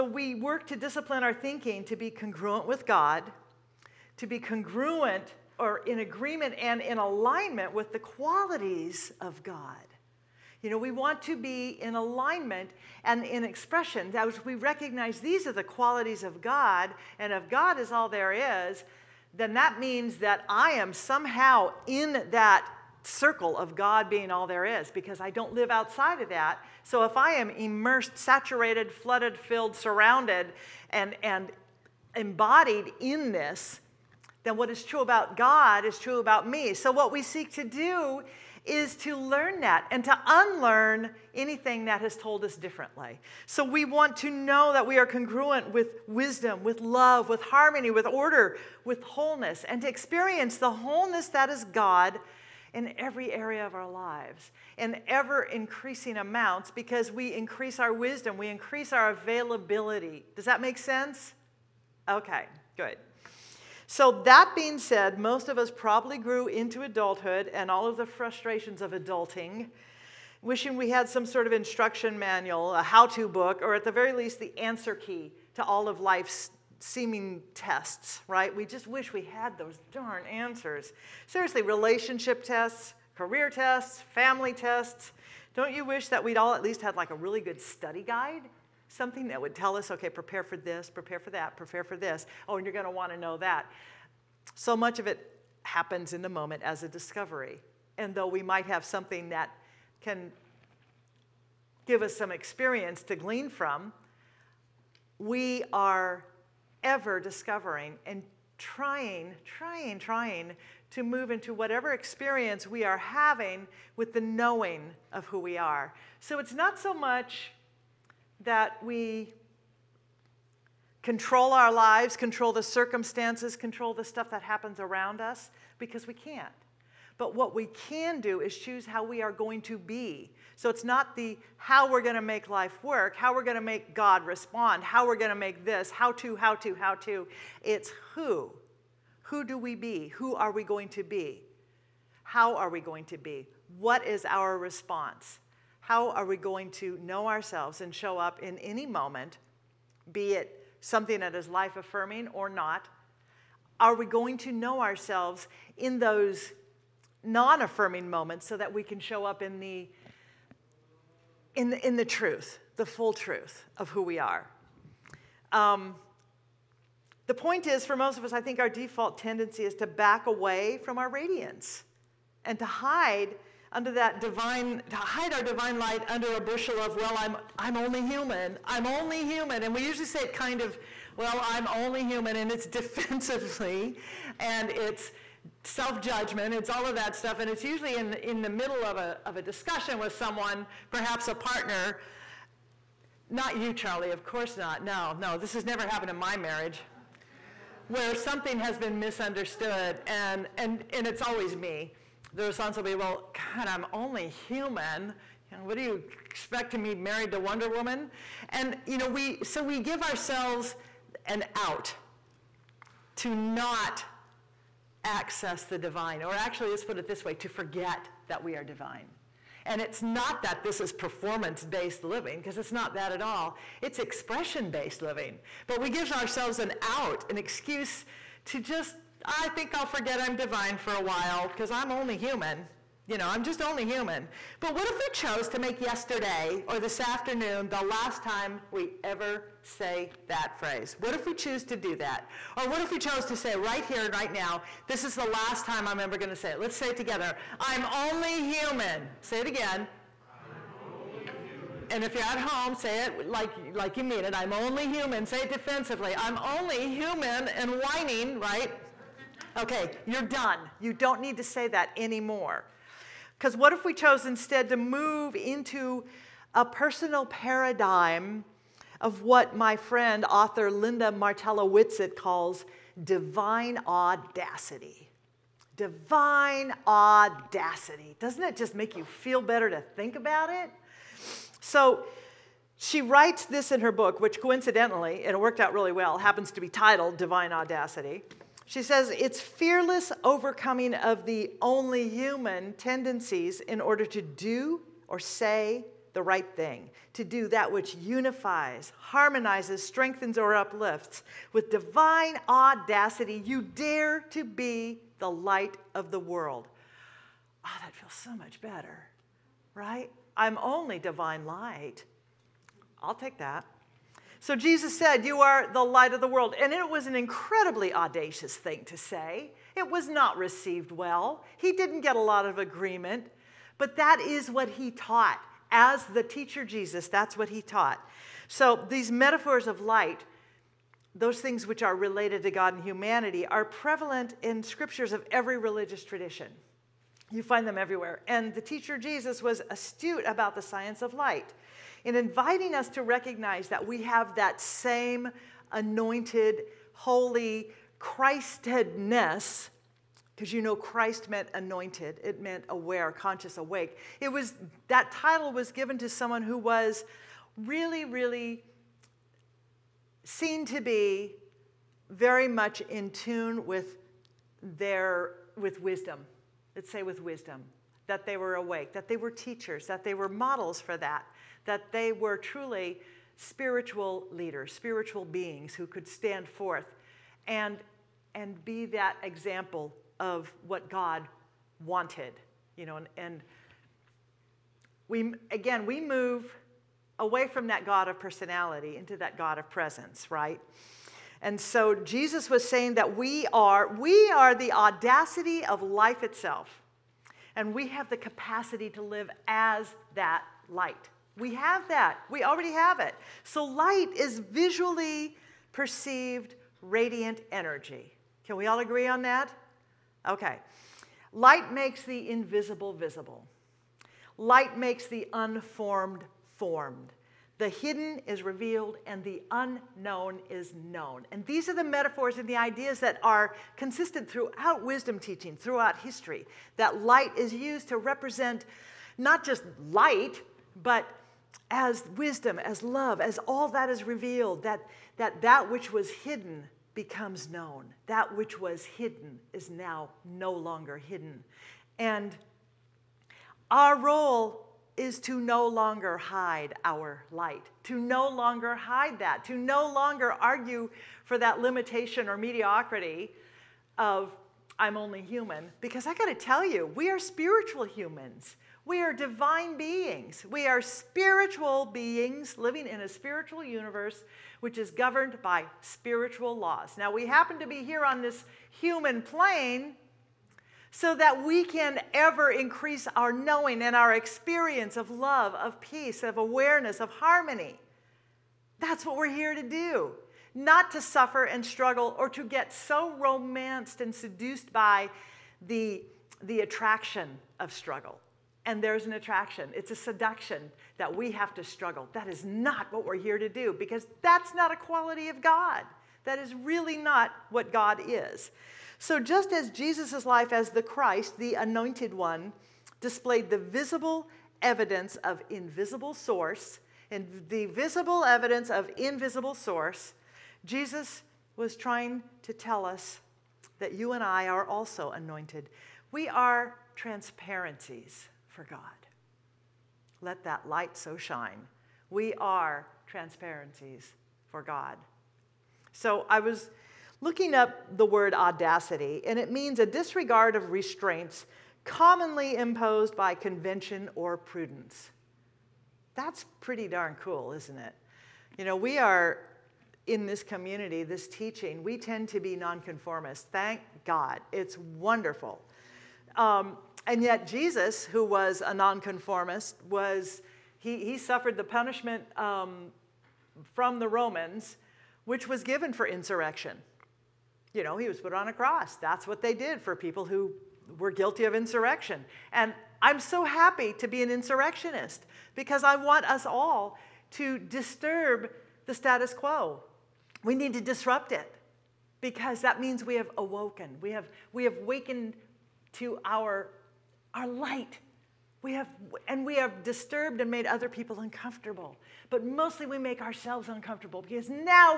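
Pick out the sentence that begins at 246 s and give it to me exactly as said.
Let's say it together I'm only human.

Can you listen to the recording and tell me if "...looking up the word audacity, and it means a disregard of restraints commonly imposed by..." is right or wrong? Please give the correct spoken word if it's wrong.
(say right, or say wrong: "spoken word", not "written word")
right.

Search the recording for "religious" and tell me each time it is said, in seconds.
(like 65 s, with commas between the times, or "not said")
335 s.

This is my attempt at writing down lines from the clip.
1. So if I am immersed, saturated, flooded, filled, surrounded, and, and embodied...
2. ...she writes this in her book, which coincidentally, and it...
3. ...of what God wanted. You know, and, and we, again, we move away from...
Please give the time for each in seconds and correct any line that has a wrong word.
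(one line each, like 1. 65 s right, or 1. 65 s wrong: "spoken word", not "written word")
1. 26 s right
2. 282 s right
3. 380 s right.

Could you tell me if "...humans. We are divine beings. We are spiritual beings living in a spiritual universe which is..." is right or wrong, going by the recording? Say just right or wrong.
right.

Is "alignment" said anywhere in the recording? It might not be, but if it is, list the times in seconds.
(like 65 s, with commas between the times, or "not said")
6 s, 11 s.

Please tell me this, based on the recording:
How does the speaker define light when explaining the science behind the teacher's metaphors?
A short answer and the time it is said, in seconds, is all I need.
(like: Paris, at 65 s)
visually perceived radiant energy, at 404 s.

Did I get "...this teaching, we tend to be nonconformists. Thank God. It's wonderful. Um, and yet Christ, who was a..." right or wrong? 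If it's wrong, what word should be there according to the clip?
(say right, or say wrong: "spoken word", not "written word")
wrong: "Jesus", not "Christ".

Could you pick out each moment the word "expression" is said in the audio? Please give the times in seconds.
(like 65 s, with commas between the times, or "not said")
13 s, 223 s.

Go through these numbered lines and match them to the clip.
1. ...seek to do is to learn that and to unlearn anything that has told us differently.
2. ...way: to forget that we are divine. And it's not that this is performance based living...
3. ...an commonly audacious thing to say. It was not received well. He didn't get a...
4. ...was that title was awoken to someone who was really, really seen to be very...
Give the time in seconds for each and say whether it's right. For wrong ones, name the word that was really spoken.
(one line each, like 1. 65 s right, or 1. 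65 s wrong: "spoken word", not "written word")
1. 37 s right
2. 217 s right
3. 317 s wrong: "incredibly", not "commonly"
4. 354 s wrong: "given", not "awoken".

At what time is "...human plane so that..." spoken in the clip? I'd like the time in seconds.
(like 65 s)
468 s.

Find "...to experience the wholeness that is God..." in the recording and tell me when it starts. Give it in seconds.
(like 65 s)
49 s.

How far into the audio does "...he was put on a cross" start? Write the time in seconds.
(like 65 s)
557 s.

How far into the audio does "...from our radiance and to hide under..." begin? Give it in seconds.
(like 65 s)
170 s.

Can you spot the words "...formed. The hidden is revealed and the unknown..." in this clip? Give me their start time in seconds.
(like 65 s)
416 s.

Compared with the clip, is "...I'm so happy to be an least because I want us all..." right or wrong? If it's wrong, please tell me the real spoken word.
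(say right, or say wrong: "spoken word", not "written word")
wrong: "insurrectionist", not "least".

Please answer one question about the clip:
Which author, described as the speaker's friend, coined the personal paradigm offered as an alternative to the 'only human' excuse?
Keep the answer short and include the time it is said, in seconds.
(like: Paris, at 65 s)
Linda Martella Whitsett, at 270 s.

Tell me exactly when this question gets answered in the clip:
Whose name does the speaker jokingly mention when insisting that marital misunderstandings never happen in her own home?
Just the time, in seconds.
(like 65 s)
193 s.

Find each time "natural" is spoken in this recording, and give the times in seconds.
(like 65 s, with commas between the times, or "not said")
not said.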